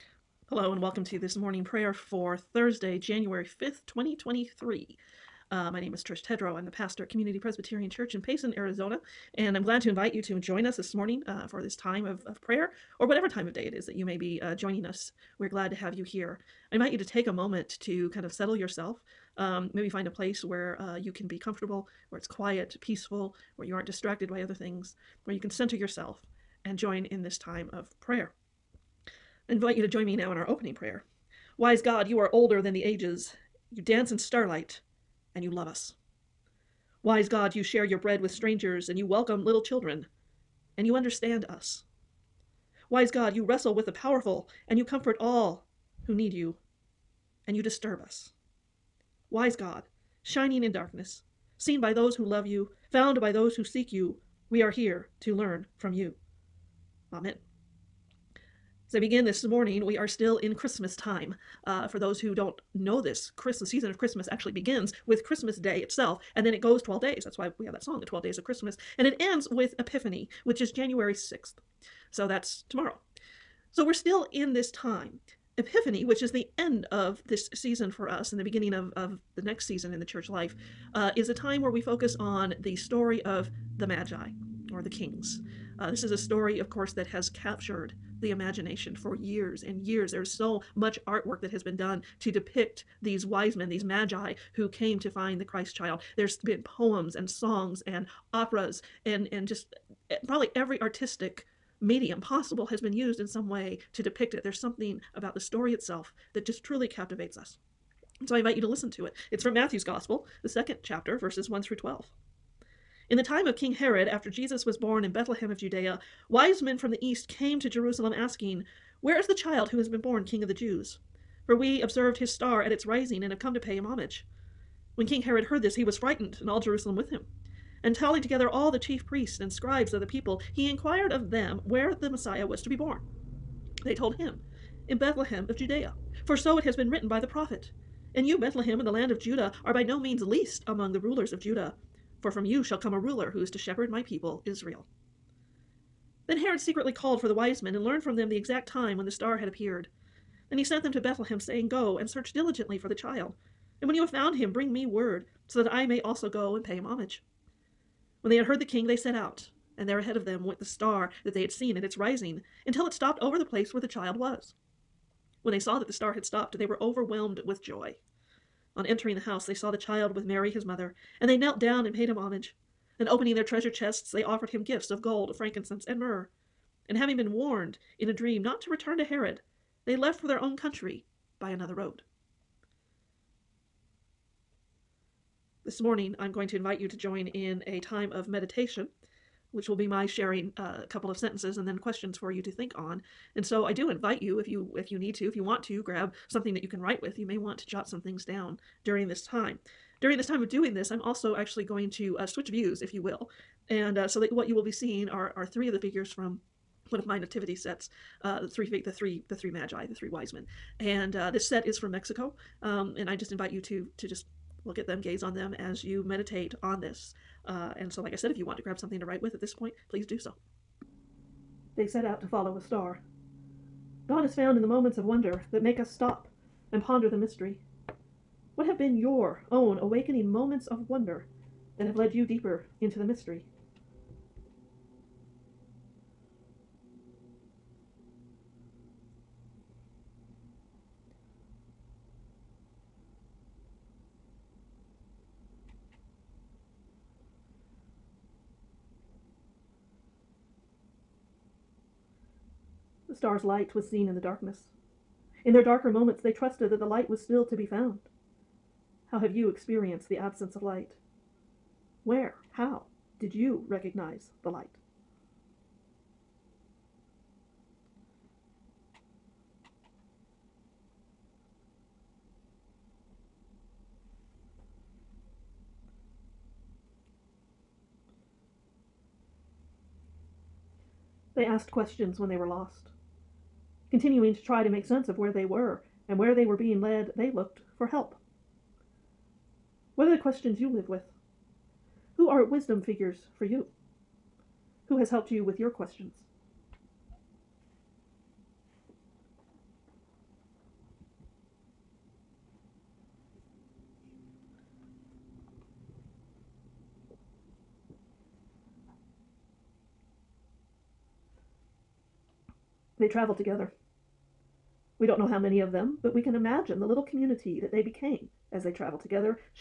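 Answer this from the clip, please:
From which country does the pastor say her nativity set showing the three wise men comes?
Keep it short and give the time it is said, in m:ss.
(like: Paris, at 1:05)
Mexico, at 3:31.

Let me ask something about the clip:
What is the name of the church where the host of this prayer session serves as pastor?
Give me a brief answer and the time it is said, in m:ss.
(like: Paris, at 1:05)
Community Presbyterian Church, at 0:07.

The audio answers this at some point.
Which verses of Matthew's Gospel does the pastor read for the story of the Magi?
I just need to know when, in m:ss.
1:51.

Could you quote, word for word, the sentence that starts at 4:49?
What are the questions you live with?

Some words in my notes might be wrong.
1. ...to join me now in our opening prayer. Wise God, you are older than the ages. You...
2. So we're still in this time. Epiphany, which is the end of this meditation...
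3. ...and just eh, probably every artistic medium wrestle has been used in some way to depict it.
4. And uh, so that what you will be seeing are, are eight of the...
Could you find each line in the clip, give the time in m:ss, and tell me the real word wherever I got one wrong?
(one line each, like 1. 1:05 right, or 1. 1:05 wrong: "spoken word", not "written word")
1. 0:29 right
2. 1:13 wrong: "season", not "meditation"
3. 1:39 wrong: "possible", not "wrestle"
4. 3:23 wrong: "three", not "eight".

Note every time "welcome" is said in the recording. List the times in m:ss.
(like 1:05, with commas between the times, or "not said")
0:00, 0:39.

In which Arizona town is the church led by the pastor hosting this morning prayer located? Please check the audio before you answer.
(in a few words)
Payson.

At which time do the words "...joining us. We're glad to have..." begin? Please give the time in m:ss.
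0:14.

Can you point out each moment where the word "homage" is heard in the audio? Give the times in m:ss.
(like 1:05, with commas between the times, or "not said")
2:03, 2:36, 2:52.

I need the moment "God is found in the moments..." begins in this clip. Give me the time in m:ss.
3:44.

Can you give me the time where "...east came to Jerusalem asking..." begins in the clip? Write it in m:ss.
1:57.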